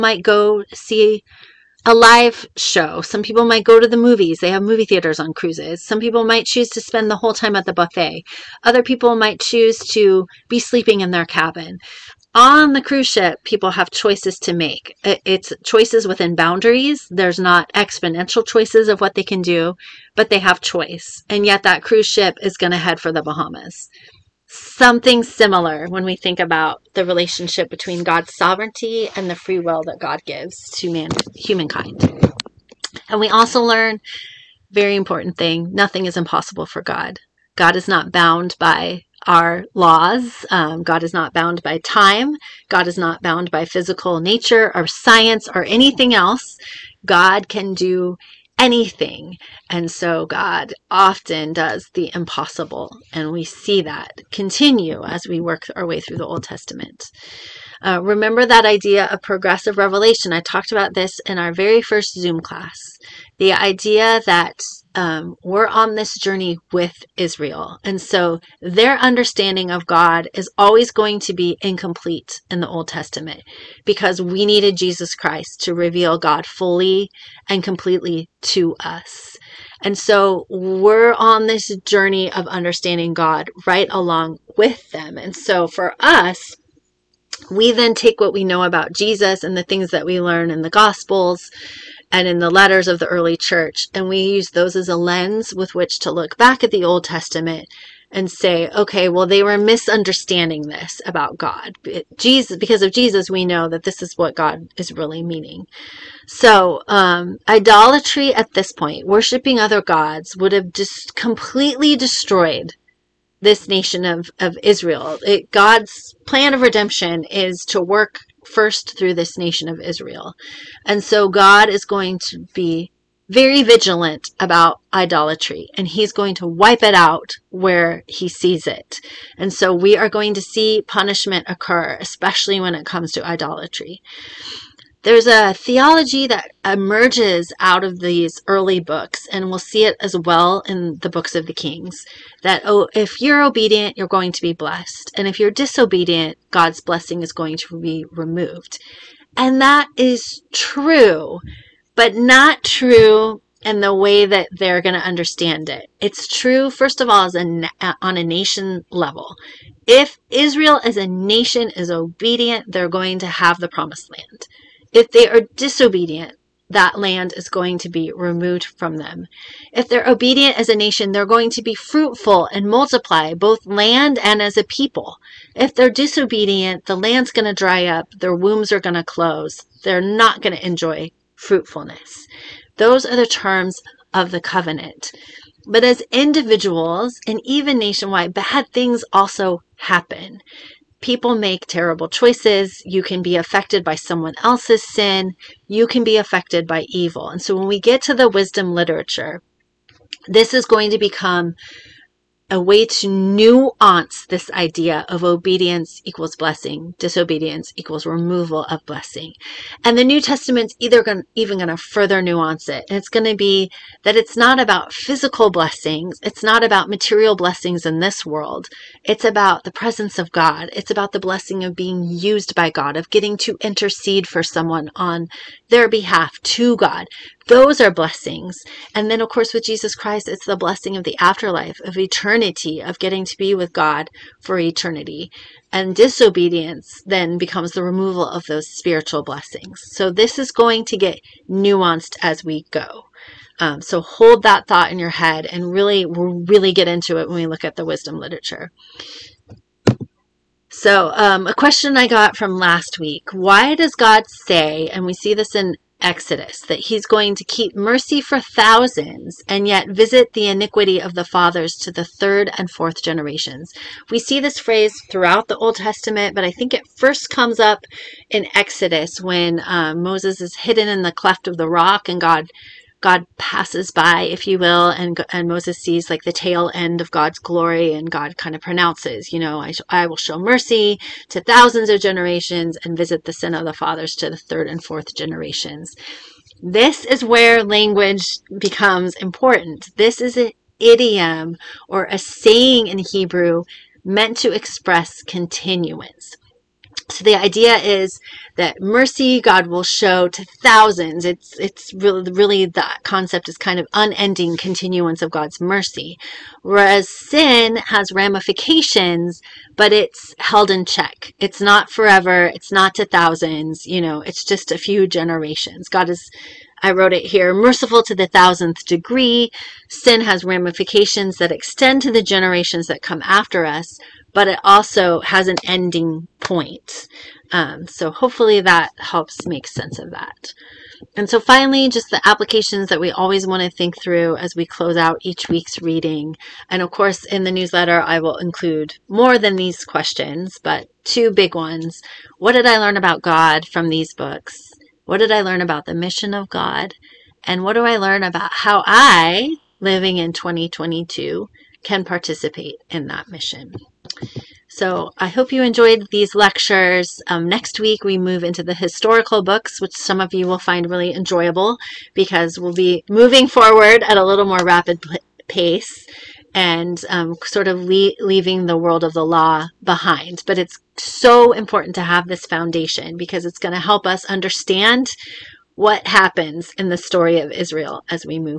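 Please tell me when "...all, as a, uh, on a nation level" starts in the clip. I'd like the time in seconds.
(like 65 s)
157 s.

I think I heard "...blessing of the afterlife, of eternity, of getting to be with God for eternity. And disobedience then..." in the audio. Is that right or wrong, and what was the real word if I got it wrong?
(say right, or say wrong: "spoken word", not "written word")
right.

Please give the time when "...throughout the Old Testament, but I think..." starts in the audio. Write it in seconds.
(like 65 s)
265 s.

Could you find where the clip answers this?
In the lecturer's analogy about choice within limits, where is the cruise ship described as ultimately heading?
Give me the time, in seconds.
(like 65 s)
23 s.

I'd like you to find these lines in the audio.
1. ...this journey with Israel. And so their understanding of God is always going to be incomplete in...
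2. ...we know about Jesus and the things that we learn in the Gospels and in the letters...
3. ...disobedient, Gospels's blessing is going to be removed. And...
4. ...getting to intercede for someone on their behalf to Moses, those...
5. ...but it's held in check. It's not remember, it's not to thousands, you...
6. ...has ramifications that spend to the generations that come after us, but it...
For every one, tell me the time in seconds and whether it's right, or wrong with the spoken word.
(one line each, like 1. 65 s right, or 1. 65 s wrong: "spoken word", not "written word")
1. 65 s right
2. 88 s right
3. 145 s wrong: "God", not "Gospels"
4. 223 s wrong: "God", not "Moses"
5. 309 s wrong: "forever", not "remember"
6. 320 s wrong: "extend", not "spend".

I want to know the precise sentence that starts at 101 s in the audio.
It, Jesus, because of Jesus, we know that this is what God is really meaning.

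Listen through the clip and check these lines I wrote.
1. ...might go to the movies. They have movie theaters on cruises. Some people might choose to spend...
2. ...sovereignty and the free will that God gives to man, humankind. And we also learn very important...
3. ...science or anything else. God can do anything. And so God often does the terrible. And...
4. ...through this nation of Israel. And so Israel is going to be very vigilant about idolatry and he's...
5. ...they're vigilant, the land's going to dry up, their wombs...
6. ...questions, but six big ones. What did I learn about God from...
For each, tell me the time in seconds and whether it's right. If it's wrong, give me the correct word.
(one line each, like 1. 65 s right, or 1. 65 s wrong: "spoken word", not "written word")
1. 3 s right
2. 28 s right
3. 44 s wrong: "impossible", not "terrible"
4. 118 s wrong: "God", not "Israel"
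5. 175 s wrong: "disobedient", not "vigilant"
6. 339 s wrong: "two", not "six".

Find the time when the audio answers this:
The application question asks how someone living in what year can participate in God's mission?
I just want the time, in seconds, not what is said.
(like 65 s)
350 s.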